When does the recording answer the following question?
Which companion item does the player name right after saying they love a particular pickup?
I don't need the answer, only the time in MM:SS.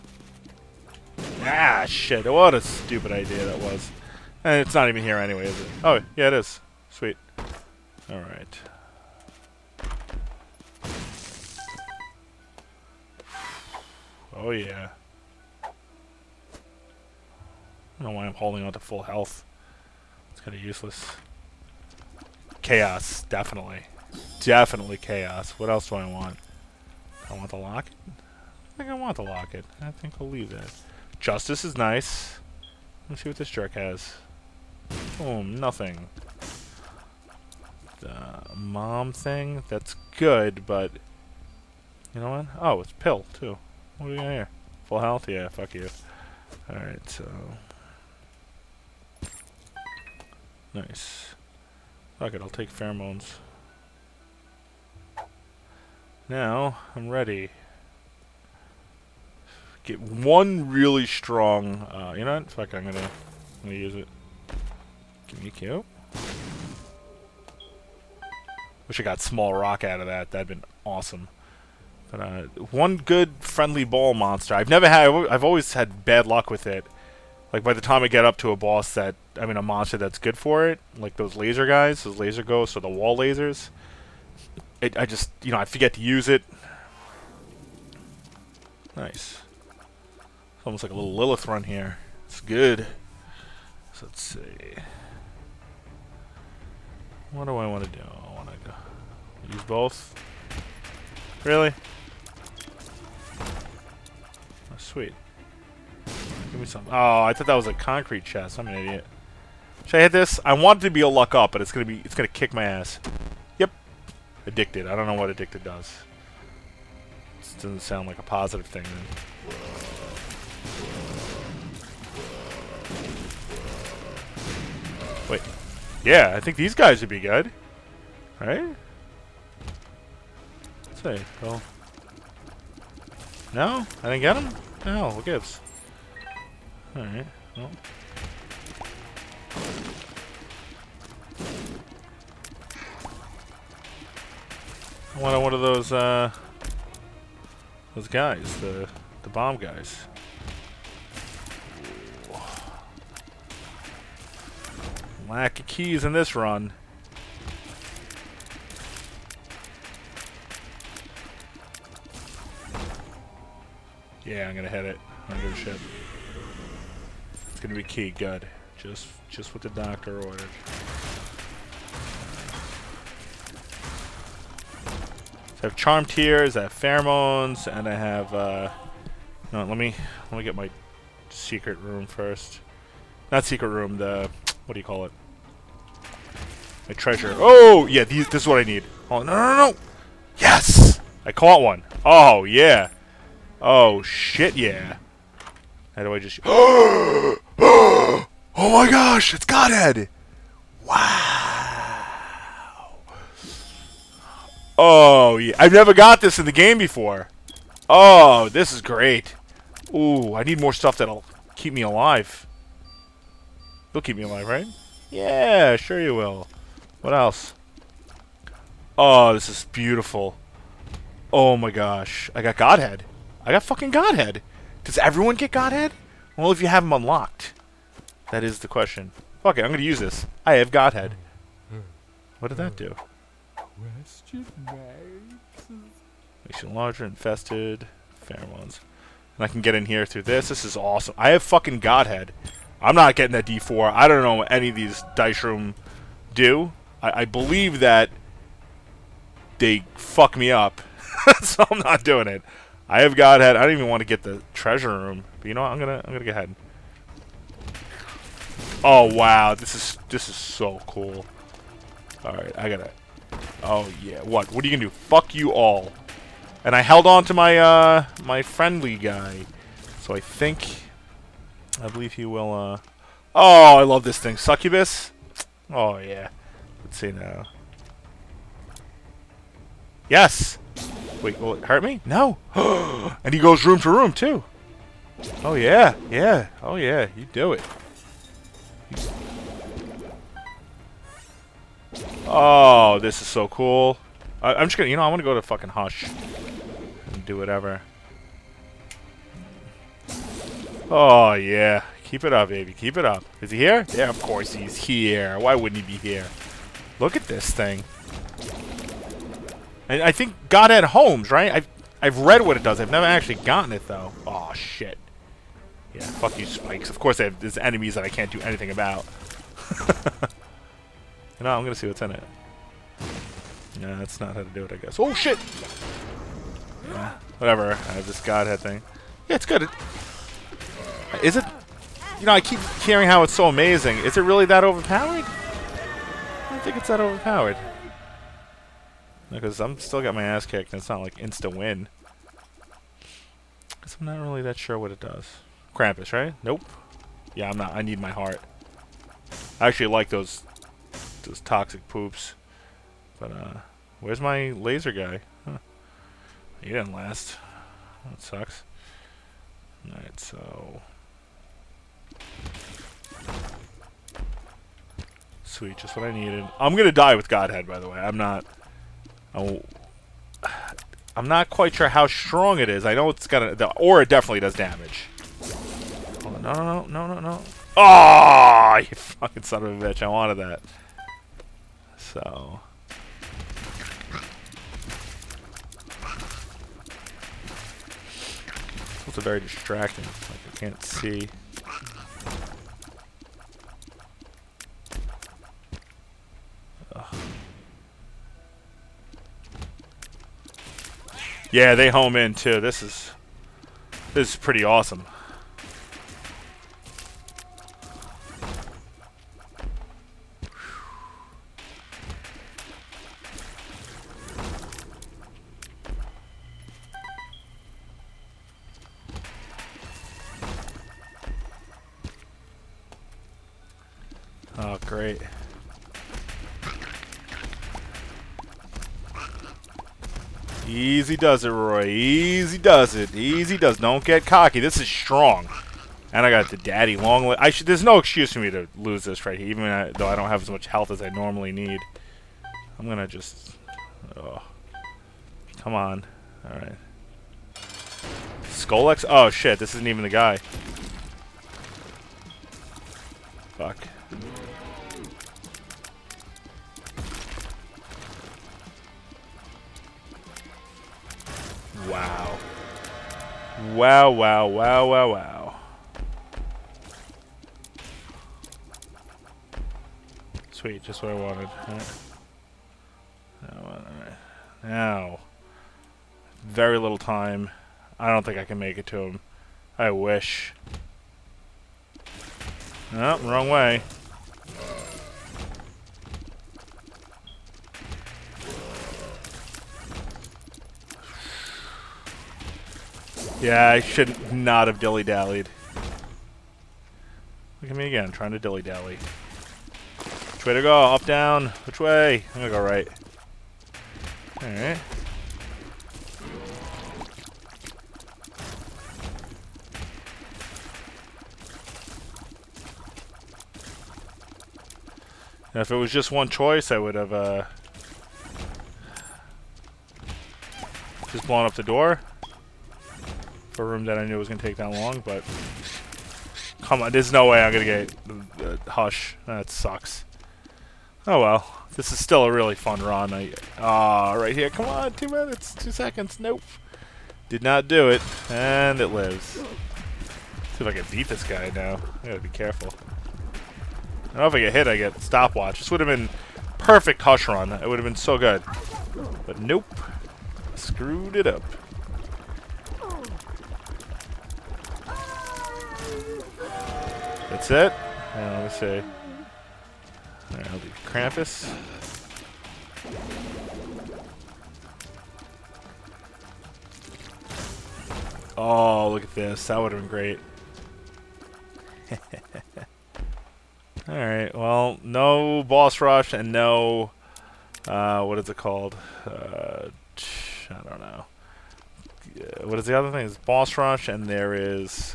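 04:34.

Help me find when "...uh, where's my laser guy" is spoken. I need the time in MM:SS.
05:53.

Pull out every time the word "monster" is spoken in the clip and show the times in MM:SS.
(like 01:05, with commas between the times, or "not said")
01:14, 01:19.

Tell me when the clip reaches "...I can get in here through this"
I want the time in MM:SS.
03:59.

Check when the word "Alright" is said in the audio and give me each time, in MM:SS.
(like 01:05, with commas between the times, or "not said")
00:46, 02:16, 04:22, 05:59, 08:24, 09:20, 09:33.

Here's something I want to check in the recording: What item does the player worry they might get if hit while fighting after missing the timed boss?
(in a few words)
stopwatch.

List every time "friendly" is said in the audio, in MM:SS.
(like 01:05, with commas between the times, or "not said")
01:13, 04:28.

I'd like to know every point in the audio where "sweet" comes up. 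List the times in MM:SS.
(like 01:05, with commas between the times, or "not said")
00:06, 01:44, 06:05, 07:50.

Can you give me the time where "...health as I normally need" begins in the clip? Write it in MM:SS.
07:20.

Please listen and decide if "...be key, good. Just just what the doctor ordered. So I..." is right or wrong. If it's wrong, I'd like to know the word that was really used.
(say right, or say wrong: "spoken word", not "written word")
right.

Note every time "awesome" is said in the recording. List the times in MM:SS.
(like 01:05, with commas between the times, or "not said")
01:10, 04:00, 06:44.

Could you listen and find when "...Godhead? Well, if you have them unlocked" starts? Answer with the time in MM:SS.
03:45.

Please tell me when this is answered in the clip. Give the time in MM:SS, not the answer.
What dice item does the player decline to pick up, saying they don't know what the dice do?
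04:03.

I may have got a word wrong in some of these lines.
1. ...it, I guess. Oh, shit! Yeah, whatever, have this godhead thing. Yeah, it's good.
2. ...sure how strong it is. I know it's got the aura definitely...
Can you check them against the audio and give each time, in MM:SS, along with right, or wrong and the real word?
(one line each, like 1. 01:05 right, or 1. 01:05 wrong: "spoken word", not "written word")
1. 05:24 right
2. 06:11 right.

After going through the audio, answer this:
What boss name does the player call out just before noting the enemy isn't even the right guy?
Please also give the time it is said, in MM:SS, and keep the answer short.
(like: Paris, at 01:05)
Scolex, at 07:28.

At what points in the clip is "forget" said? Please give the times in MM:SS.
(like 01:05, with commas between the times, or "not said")
01:25.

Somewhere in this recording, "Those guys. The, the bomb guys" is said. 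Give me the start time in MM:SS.
02:27.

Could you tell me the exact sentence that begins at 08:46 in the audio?
Come on, there's no way I'm going to get...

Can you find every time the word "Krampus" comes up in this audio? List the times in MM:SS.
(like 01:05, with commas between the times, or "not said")
05:45, 09:20.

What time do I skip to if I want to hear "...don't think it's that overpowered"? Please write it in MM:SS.
05:36.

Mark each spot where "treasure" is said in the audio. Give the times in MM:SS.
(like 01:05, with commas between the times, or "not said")
03:06, 04:14.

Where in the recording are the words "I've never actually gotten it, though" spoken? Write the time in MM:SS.
05:12.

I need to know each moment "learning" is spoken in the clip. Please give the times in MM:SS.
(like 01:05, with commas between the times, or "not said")
not said.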